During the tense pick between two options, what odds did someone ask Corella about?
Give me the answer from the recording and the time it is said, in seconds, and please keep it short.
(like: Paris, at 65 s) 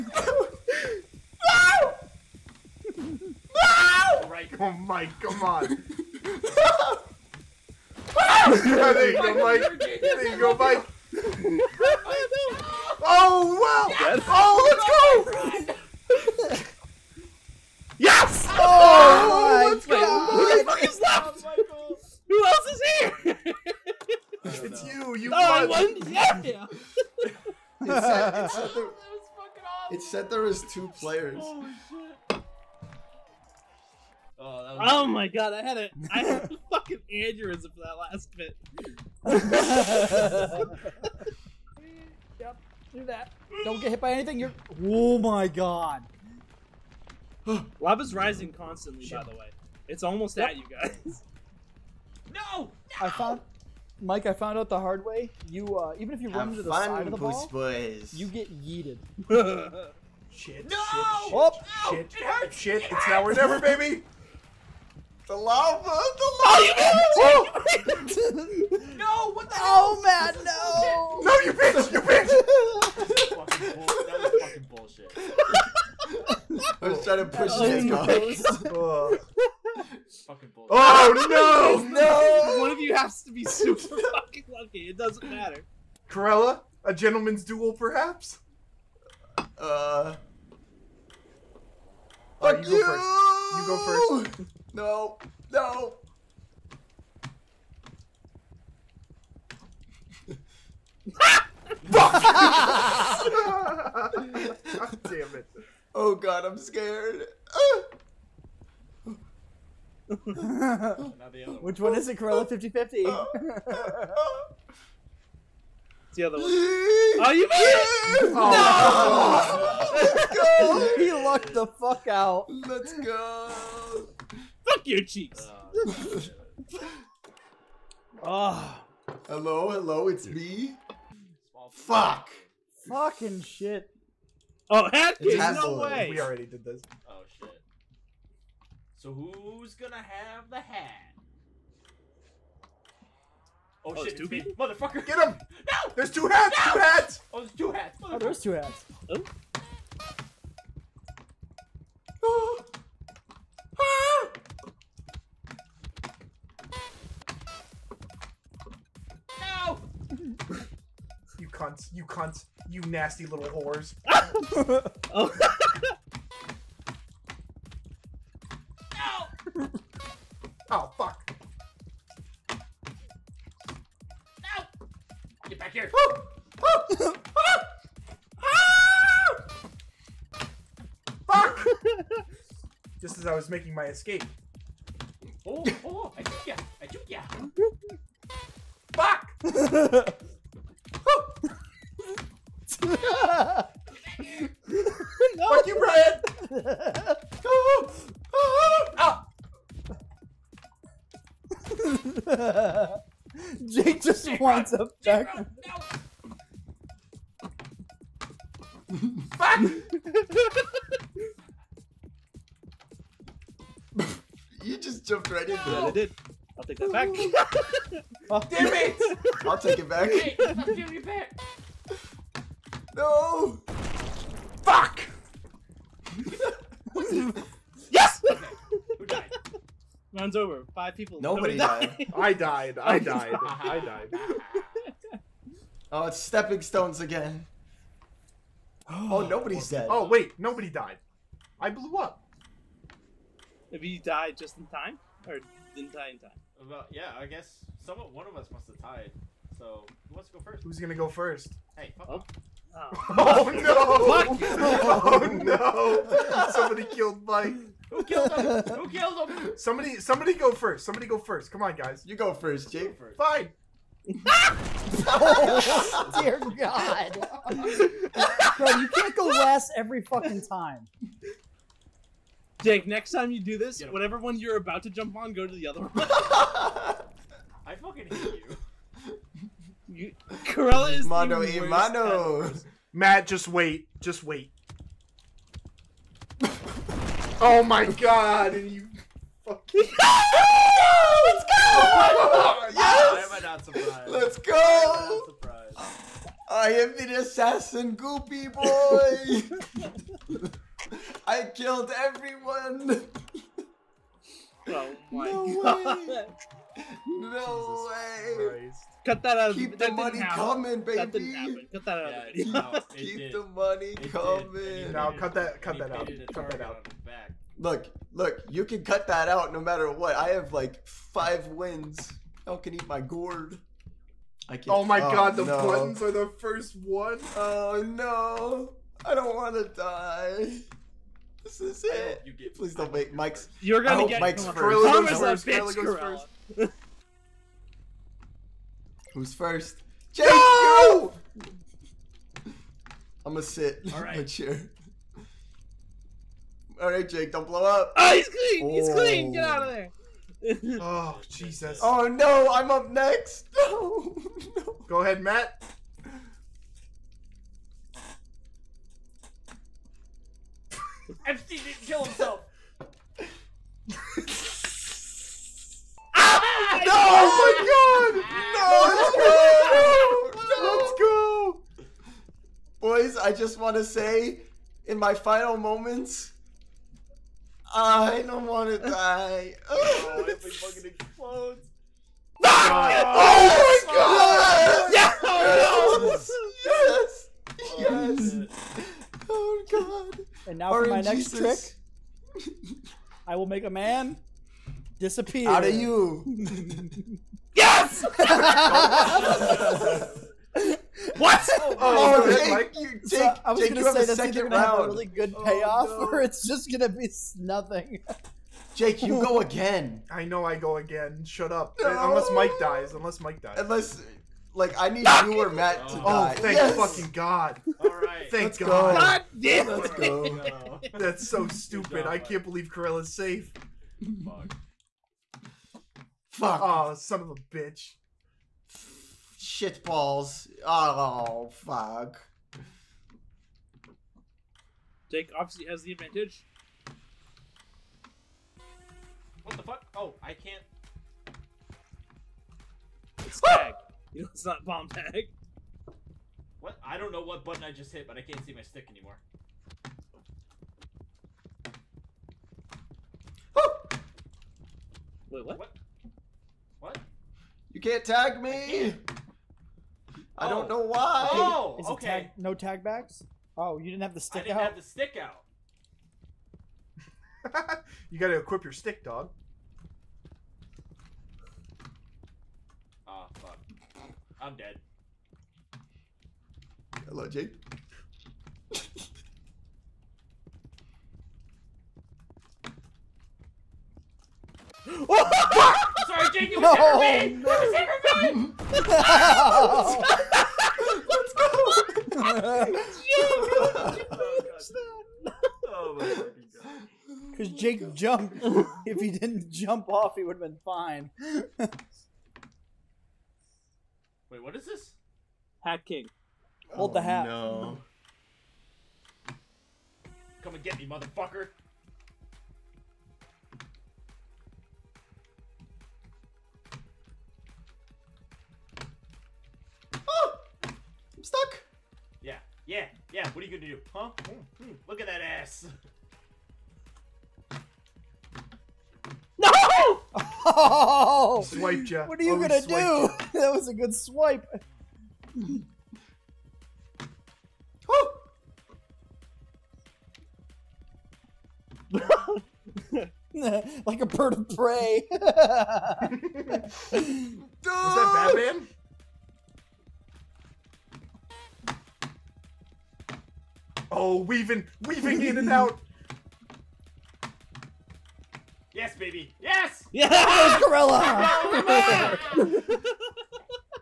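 50/50, at 112 s.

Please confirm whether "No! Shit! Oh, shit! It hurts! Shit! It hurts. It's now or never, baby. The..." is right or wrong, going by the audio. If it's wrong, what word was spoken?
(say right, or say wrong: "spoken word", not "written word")
right.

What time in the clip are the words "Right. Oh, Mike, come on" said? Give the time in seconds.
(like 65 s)
4 s.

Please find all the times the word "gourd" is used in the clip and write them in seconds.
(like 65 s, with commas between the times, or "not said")
323 s.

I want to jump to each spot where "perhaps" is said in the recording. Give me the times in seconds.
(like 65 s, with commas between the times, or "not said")
87 s.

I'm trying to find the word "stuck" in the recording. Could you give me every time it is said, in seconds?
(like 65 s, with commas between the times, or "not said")
521 s.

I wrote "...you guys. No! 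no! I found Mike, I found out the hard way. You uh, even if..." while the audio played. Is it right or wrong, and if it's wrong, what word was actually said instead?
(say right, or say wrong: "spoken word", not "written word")
right.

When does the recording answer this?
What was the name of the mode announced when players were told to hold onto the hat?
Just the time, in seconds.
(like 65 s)
505 s.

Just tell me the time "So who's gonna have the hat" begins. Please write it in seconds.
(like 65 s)
139 s.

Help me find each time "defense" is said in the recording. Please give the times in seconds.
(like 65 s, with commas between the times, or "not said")
not said.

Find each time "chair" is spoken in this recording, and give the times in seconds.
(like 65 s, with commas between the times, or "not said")
344 s.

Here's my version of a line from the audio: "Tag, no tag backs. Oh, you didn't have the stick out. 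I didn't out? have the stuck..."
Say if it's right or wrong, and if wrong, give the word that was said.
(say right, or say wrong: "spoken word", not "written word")
wrong: "stick", not "stuck".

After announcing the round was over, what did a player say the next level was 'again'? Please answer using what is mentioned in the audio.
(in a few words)
Stepping stones.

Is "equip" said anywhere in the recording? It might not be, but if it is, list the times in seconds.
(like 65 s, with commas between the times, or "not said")
468 s.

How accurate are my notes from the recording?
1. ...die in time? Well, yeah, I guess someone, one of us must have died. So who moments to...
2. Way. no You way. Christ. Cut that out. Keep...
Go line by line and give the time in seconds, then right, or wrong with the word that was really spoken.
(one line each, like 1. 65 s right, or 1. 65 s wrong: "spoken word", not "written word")
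1. 245 s wrong: "wants", not "moments"
2. 306 s wrong: "Jesus", not "You".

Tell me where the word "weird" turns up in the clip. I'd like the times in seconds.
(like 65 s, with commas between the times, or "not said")
not said.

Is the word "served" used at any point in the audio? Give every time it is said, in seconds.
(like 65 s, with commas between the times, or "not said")
not said.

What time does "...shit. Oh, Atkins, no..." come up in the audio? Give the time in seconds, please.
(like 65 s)
133 s.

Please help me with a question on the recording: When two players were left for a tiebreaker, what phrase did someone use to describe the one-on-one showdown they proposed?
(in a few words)
A gentleman's duel.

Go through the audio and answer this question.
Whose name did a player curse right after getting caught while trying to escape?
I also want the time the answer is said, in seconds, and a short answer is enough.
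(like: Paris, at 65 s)
Brian, at 195 s.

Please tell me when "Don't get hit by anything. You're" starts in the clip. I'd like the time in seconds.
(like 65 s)
43 s.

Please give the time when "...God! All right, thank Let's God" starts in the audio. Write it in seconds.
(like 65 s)
417 s.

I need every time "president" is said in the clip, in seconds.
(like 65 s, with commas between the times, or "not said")
not said.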